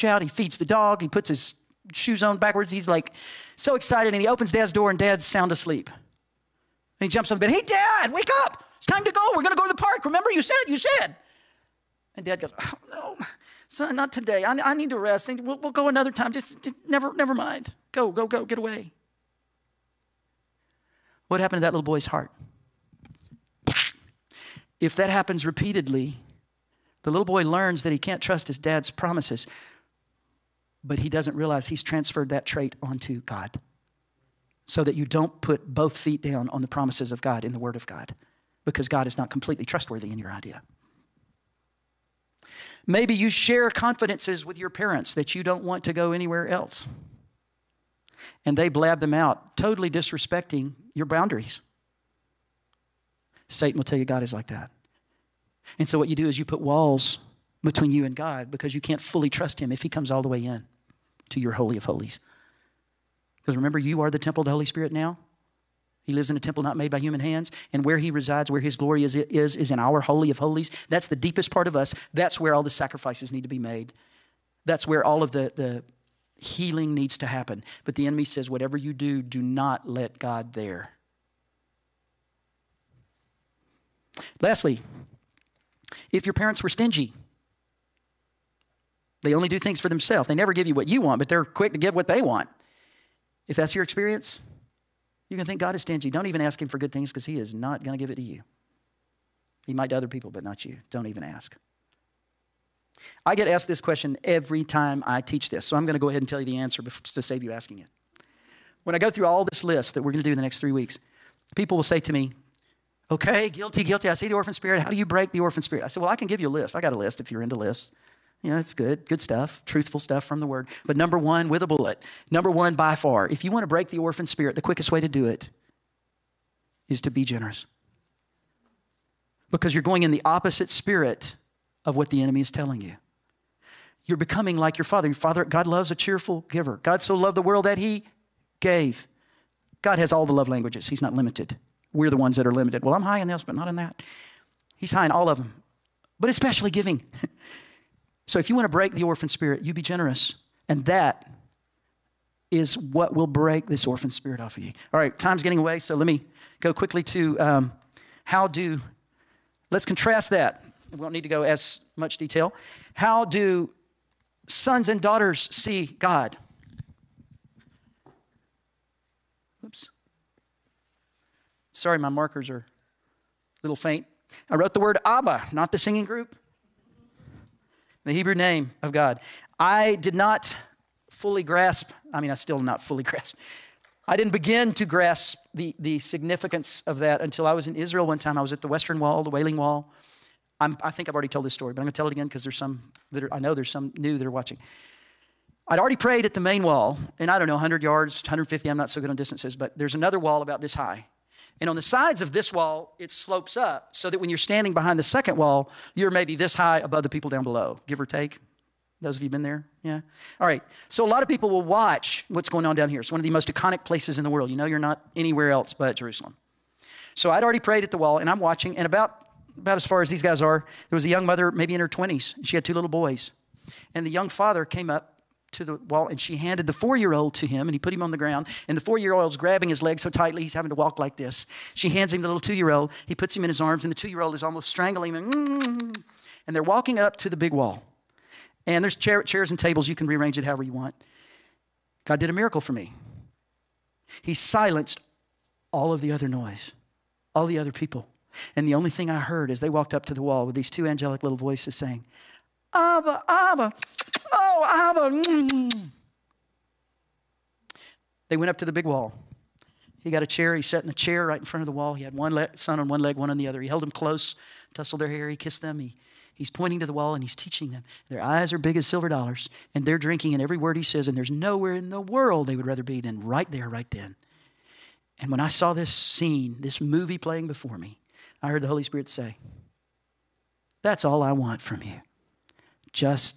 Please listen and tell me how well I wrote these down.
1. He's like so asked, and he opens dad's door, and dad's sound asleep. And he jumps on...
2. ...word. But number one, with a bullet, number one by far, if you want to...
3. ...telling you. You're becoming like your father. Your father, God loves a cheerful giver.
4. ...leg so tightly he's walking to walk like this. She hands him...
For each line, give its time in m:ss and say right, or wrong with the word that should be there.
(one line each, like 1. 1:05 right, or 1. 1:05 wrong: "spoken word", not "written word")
1. 0:02 wrong: "excited", not "asked"
2. 2:00 right
3. 2:12 right
4. 3:49 wrong: "having", not "walking".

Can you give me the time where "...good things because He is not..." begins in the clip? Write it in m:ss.
1:36.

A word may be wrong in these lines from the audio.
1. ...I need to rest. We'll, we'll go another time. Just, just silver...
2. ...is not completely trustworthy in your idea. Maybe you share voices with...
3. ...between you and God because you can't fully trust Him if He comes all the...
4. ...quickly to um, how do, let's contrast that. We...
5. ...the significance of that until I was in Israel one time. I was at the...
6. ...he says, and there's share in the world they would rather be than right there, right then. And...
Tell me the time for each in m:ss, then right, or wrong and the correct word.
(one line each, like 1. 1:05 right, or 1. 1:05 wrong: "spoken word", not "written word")
1. 0:14 wrong: "never", not "silver"
2. 0:39 wrong: "confidences", not "voices"
3. 0:57 right
4. 2:36 right
5. 3:05 right
6. 4:30 wrong: "nowhere", not "share".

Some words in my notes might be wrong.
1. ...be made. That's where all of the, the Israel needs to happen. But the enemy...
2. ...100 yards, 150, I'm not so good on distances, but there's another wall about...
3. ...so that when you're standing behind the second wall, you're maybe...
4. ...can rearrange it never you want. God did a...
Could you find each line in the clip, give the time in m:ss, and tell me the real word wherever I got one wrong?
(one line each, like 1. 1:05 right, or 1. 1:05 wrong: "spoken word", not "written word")
1. 1:13 wrong: "Healing", not "Israel"
2. 3:17 right
3. 3:23 right
4. 3:59 wrong: "however", not "never".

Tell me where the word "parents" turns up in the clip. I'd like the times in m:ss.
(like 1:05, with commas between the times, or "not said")
0:44, 1:26.